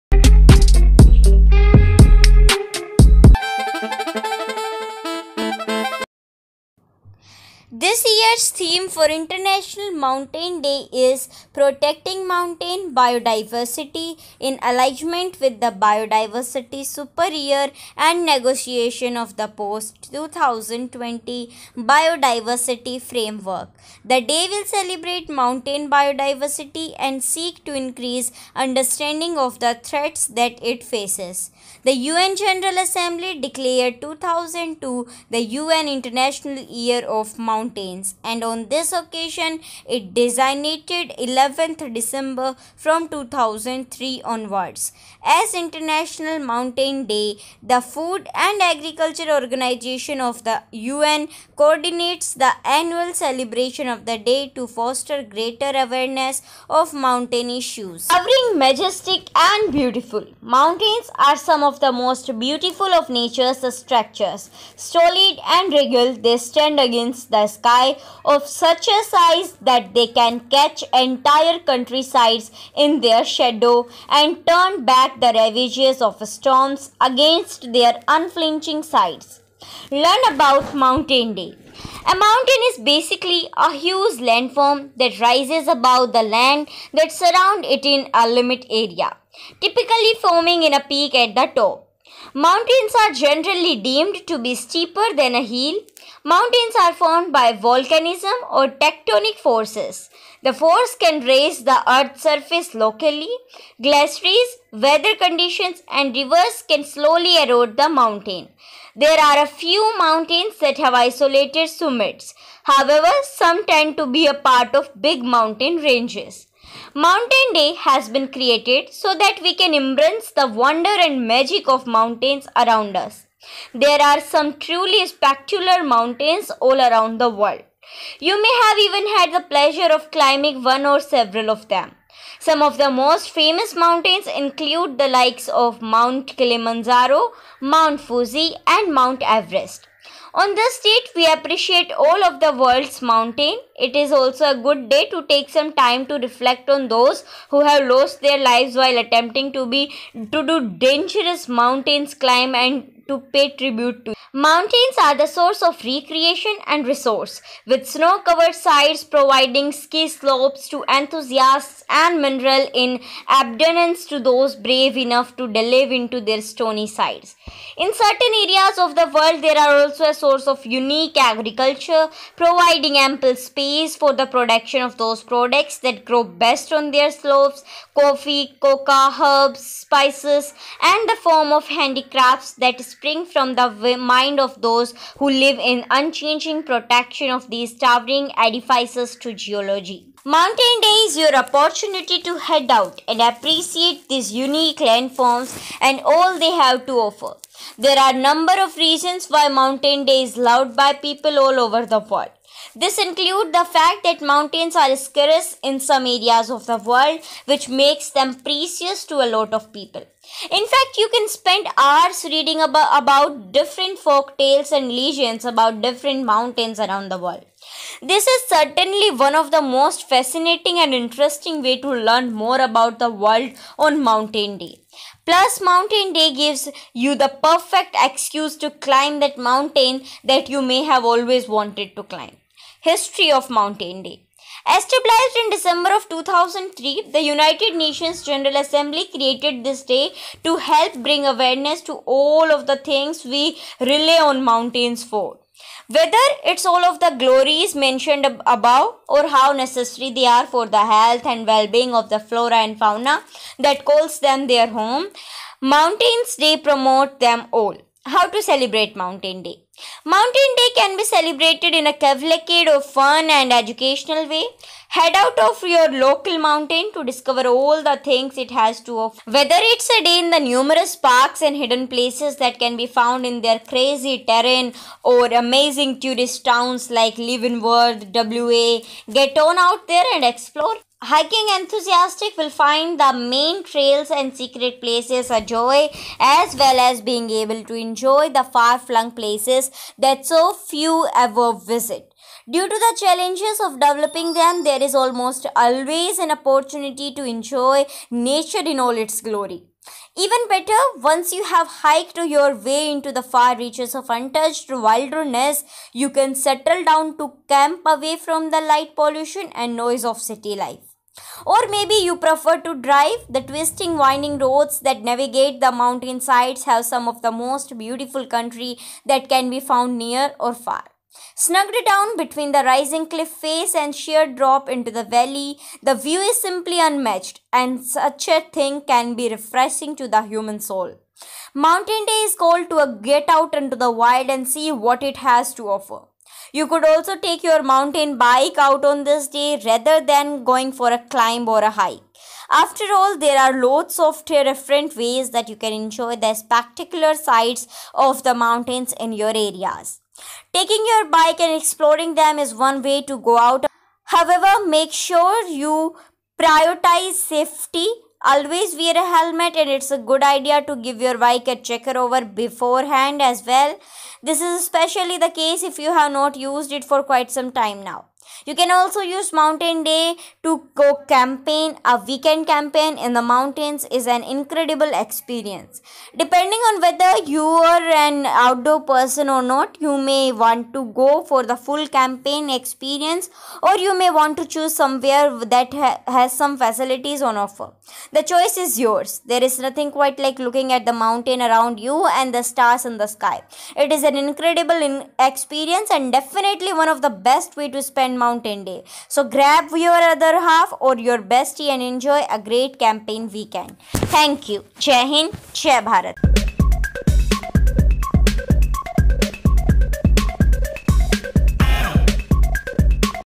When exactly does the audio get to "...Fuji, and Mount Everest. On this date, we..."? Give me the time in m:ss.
2:17.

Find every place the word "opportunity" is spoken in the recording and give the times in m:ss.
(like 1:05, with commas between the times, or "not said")
3:11, 4:56.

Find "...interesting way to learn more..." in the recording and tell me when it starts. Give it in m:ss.
3:40.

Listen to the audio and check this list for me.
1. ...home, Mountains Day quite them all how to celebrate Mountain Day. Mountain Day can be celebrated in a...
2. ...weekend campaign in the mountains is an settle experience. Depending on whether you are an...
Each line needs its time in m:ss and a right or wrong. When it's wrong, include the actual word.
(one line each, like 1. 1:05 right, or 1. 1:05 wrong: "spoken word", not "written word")
1. 4:14 wrong: "promote", not "quite"
2. 6:12 wrong: "incredible", not "settle".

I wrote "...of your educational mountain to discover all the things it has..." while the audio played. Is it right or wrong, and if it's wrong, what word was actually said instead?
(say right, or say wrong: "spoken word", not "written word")
wrong: "local", not "educational".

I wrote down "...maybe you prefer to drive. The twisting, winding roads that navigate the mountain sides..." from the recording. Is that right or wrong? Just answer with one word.
right.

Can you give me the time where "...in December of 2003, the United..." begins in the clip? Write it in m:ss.
3:55.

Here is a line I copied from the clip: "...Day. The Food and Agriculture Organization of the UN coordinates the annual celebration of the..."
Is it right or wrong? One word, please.
right.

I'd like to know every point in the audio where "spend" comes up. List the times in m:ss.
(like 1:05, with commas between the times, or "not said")
3:31, 6:37.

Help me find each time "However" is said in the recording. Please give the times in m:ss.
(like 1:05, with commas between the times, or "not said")
1:52, 5:54.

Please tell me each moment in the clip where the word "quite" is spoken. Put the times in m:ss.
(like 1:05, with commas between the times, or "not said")
6:07, 6:29.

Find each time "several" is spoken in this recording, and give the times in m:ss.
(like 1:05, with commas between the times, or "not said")
2:10.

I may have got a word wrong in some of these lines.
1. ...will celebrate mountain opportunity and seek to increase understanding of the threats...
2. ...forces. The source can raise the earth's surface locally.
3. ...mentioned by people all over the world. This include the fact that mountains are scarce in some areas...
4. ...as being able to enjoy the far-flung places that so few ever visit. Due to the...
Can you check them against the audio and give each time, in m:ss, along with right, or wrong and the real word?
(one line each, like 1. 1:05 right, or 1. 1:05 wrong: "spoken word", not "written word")
1. 0:24 wrong: "biodiversity", not "opportunity"
2. 1:39 wrong: "force", not "source"
3. 3:20 wrong: "loved", not "mentioned"
4. 4:46 right.